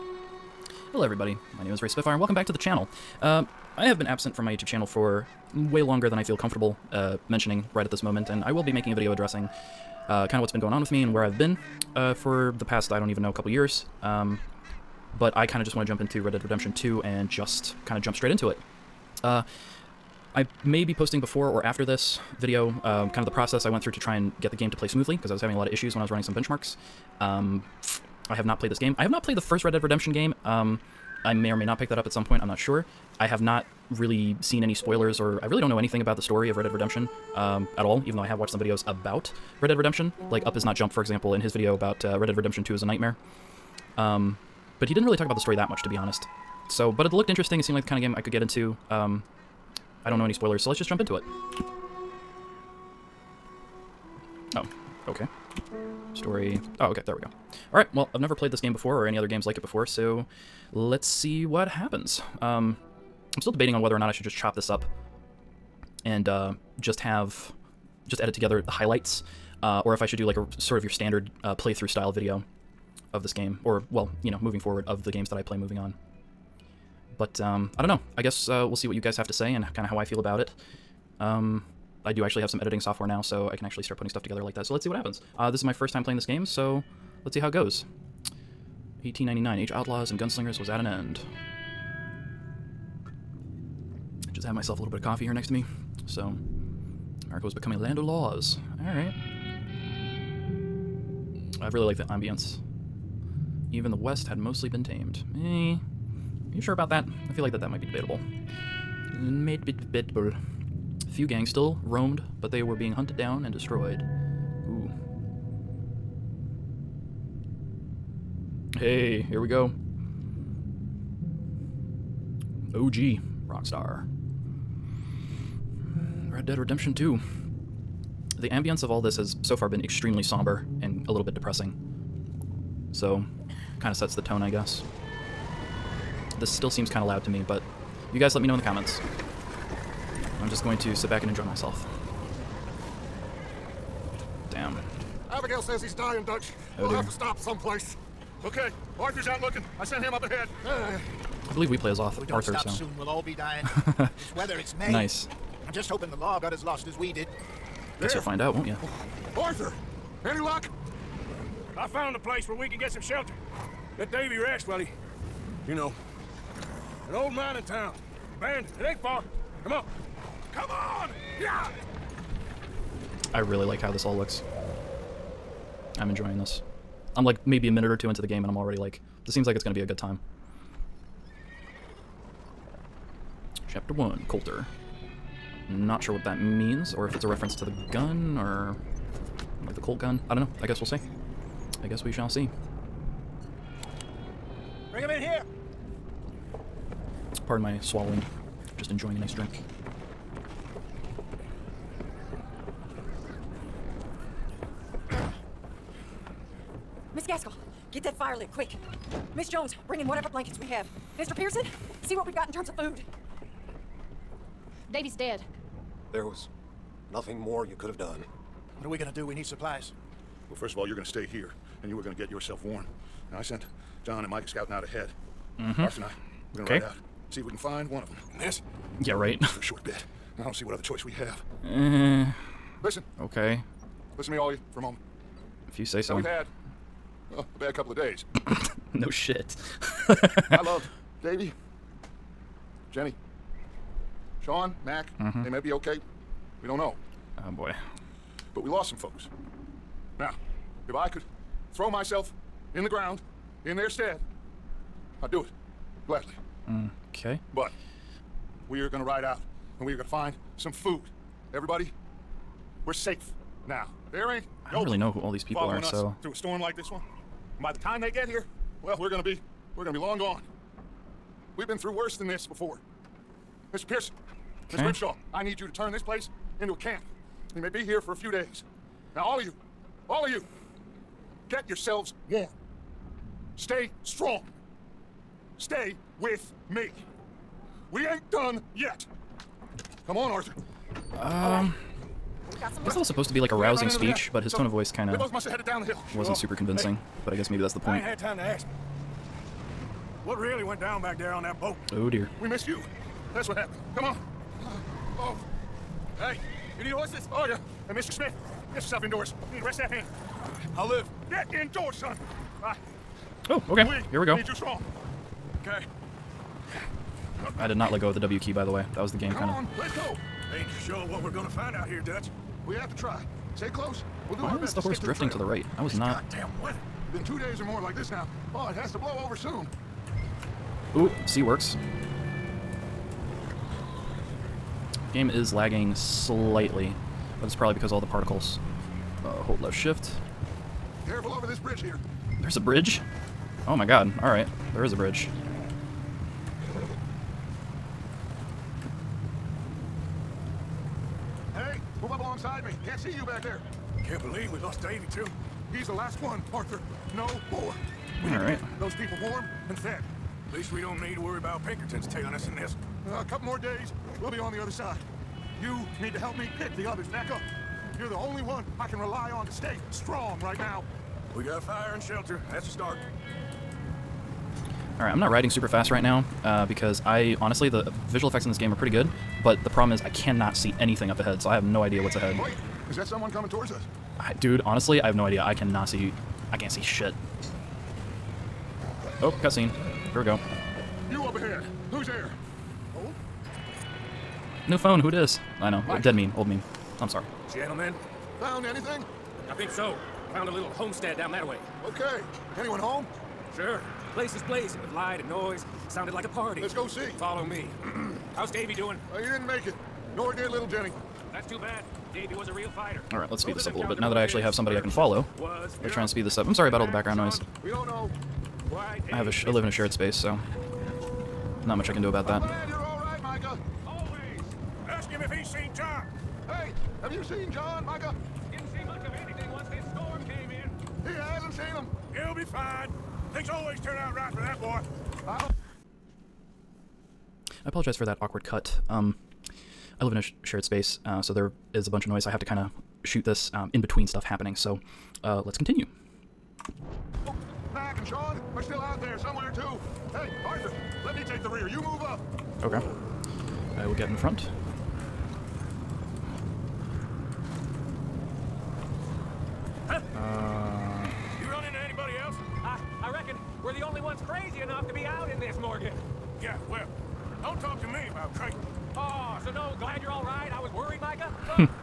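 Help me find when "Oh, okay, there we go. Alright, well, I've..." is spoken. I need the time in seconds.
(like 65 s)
56 s.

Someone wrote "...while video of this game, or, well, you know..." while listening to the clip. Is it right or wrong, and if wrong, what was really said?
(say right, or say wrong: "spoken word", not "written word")
wrong: "style", not "while".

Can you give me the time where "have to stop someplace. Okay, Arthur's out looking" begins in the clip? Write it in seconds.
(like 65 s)
146 s.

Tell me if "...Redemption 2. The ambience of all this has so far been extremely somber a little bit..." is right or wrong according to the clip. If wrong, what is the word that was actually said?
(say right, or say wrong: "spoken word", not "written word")
right.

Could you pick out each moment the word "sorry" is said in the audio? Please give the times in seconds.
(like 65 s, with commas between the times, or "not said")
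397 s, 416 s.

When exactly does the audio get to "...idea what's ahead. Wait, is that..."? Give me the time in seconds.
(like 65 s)
381 s.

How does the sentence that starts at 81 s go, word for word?
Um, I do actually have some editing software now, so I can actually start putting stuff together like that.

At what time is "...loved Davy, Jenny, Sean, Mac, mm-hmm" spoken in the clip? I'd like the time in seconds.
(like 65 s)
240 s.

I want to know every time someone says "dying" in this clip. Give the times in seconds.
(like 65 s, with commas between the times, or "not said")
145 s, 153 s.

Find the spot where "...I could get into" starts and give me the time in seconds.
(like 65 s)
48 s.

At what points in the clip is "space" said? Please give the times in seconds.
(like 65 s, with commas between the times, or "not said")
419 s, 440 s.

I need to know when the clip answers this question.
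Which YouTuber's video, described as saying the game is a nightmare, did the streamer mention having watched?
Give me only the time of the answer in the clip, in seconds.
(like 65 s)
40 s.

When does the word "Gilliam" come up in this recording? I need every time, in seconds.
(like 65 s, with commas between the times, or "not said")
not said.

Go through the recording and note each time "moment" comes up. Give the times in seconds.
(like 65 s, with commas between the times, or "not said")
8 s, 234 s.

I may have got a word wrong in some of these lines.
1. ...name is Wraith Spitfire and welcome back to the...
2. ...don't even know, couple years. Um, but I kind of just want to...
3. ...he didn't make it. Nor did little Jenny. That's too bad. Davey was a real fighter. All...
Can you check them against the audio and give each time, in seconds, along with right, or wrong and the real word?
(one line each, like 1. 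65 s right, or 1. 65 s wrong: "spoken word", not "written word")
1. 1 s right
2. 12 s right
3. 409 s right.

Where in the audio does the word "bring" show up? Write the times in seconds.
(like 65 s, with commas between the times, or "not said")
194 s, 209 s.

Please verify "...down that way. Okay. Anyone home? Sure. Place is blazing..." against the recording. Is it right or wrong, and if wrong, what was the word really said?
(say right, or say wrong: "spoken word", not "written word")
right.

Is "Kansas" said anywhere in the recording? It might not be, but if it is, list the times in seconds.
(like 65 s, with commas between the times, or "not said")
not said.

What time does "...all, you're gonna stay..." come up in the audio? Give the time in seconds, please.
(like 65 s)
220 s.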